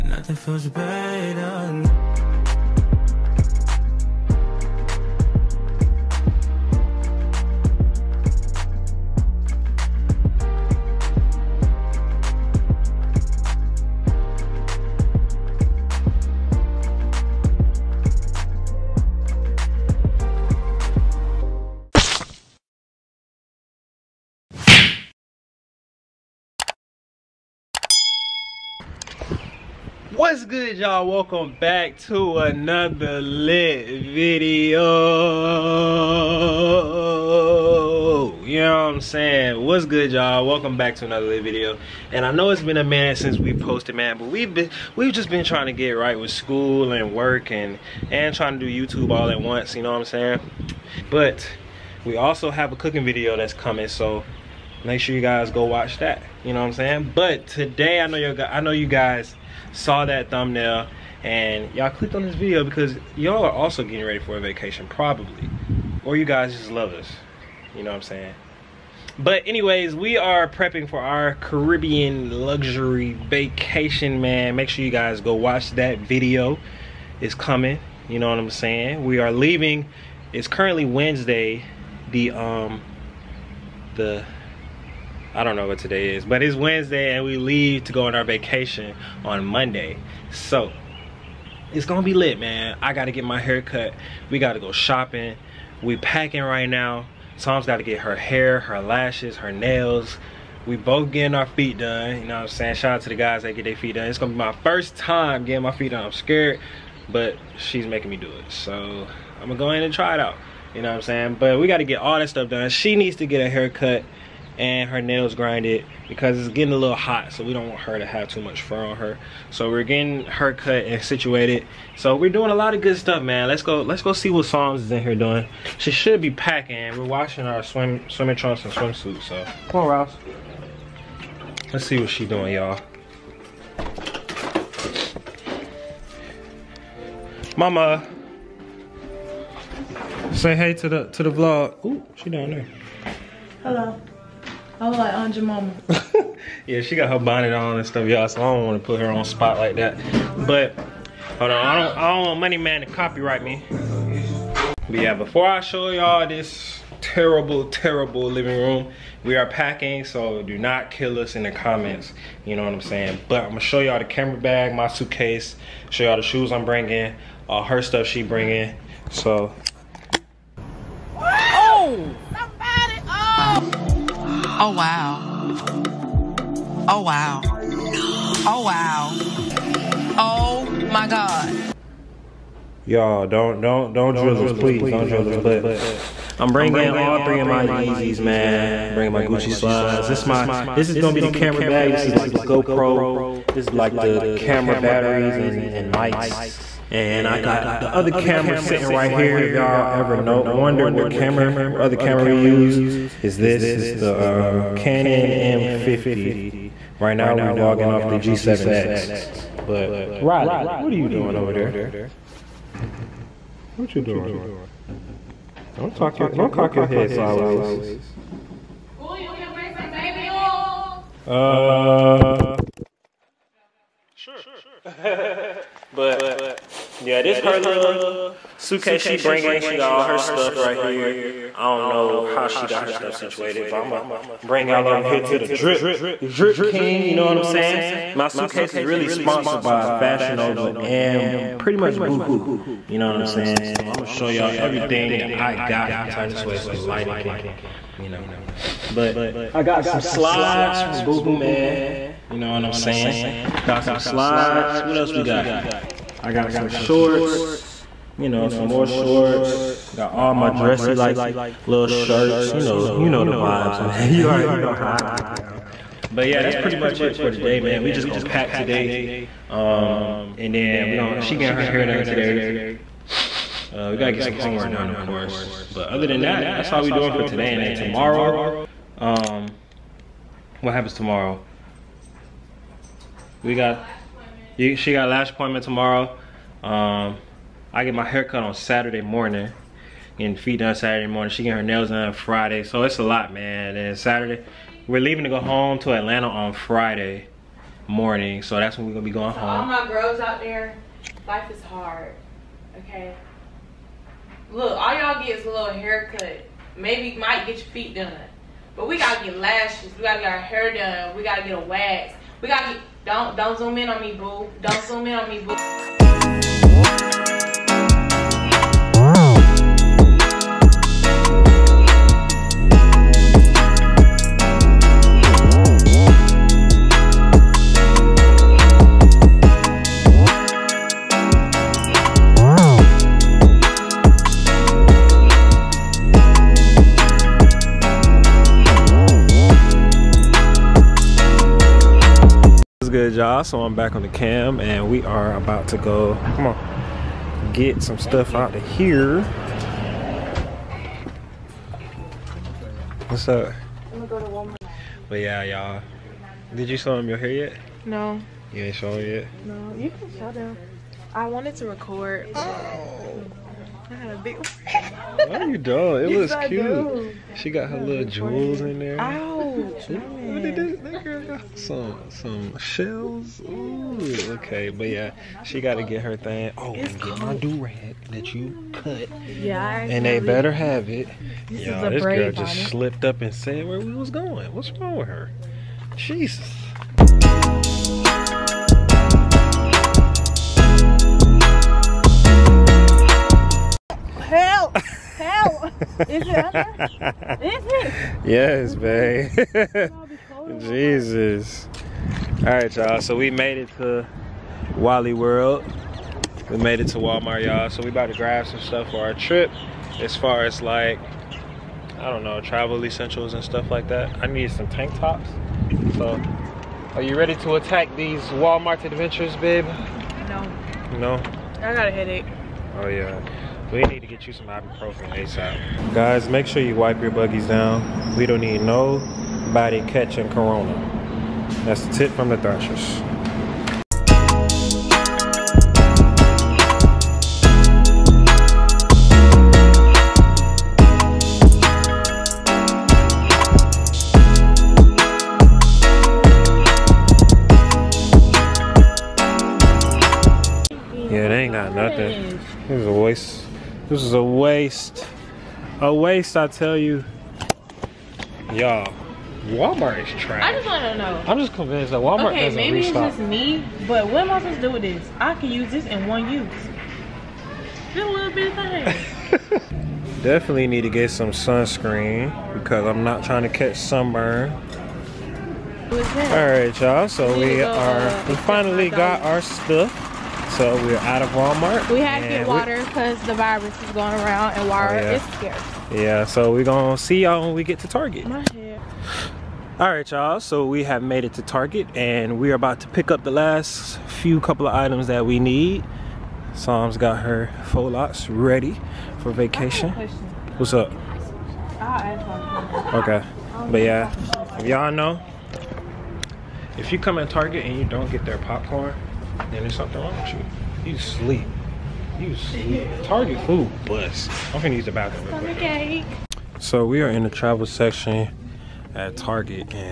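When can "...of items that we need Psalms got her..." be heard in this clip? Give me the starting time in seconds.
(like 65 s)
494 s.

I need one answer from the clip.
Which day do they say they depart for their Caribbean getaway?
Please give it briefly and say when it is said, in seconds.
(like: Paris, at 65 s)
Monday, at 89 s.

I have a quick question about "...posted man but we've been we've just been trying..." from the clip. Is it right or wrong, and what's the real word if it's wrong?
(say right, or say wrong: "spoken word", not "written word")
right.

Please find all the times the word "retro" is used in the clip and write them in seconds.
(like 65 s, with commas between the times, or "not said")
not said.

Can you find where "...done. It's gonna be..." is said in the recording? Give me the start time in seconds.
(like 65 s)
103 s.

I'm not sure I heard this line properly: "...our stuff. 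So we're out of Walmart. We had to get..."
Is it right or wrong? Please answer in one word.
right.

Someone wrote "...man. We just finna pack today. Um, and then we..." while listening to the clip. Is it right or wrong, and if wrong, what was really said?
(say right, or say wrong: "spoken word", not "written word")
wrong: "gonna", not "finna".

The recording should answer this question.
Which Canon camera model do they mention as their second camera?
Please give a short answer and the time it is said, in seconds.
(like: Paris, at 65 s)
Canon M50, at 204 s.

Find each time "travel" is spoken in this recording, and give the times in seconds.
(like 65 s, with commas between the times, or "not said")
412 s, 517 s.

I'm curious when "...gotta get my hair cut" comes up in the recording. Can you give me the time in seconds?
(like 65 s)
92 s.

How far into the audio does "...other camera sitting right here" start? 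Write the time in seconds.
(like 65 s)
197 s.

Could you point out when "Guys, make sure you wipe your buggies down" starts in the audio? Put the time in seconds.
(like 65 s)
425 s.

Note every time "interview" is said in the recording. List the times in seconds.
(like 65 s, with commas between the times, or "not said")
not said.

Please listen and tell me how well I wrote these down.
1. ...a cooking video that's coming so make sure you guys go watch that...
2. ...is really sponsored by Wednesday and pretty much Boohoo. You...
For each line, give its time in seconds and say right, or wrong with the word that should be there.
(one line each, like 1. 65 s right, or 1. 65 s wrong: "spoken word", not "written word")
1. 52 s right
2. 238 s wrong: "Fashion", not "Wednesday".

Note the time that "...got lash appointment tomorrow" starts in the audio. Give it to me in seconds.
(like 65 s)
284 s.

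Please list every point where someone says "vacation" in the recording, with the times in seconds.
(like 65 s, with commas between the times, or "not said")
64 s, 73 s, 88 s, 499 s.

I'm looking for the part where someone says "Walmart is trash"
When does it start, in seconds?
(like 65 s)
459 s.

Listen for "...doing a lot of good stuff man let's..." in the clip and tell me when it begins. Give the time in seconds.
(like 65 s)
122 s.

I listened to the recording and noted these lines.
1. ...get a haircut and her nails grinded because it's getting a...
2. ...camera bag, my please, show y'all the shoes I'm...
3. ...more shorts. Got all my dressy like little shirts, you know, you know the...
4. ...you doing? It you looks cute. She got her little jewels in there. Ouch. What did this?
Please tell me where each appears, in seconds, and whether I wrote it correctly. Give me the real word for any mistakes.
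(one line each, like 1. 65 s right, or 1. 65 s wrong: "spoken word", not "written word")
1. 113 s right
2. 164 s wrong: "suitcase", not "please"
3. 258 s right
4. 365 s right.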